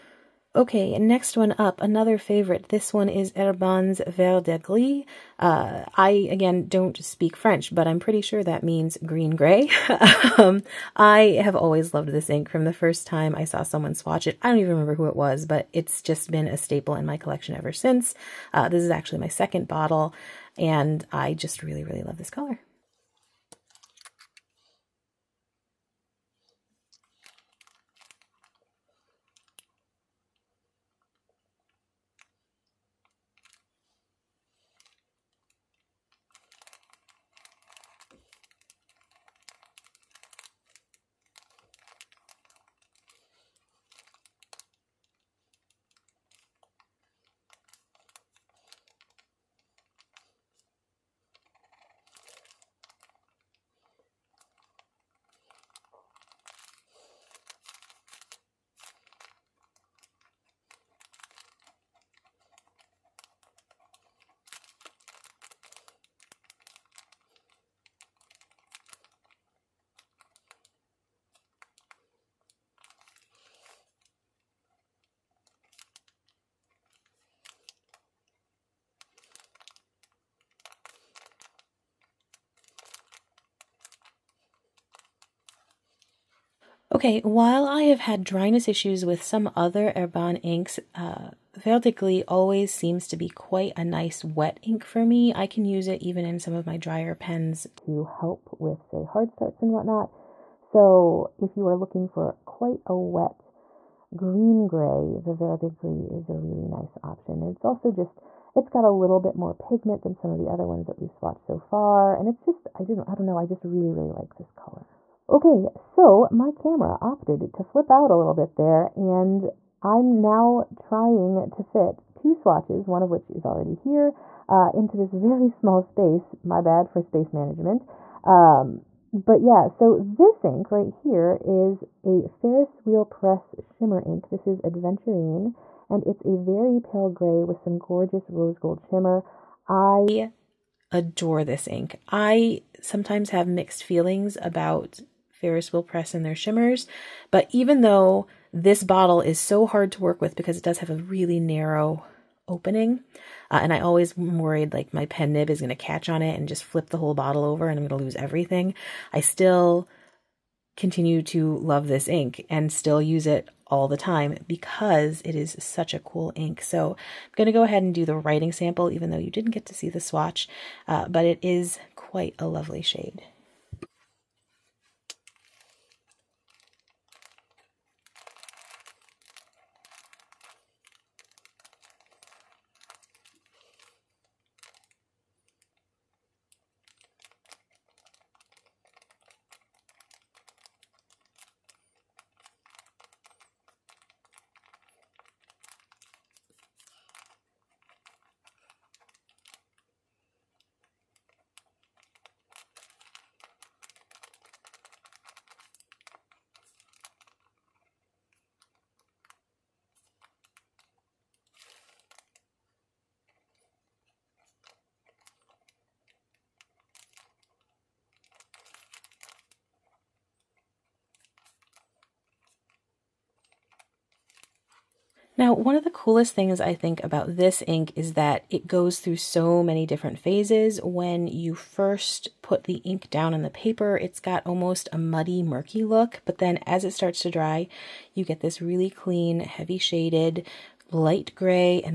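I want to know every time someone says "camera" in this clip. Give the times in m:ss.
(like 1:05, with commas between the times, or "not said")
1:56.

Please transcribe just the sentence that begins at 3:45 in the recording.
Now, one of the coolest things I think about this ink is that it goes through so many different phases.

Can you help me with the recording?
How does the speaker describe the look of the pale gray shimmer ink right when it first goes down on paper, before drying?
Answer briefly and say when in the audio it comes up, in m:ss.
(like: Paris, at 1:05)
Muddy, murky, at 3:54.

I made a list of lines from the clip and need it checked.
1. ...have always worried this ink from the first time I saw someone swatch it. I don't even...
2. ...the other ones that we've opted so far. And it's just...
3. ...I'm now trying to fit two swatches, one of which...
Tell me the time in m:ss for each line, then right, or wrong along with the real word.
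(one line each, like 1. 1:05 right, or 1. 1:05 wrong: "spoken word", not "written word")
1. 0:11 wrong: "loved", not "worried"
2. 1:50 wrong: "swatched", not "opted"
3. 1:59 right.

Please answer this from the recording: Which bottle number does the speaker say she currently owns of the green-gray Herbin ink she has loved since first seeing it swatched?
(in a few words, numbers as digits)
Second.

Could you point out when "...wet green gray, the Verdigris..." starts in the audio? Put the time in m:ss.
1:42.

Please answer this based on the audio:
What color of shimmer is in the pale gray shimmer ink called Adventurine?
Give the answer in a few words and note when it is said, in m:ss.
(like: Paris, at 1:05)
Rose gold, at 2:18.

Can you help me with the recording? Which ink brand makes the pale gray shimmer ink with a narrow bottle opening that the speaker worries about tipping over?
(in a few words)
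Ferris Wheel Press.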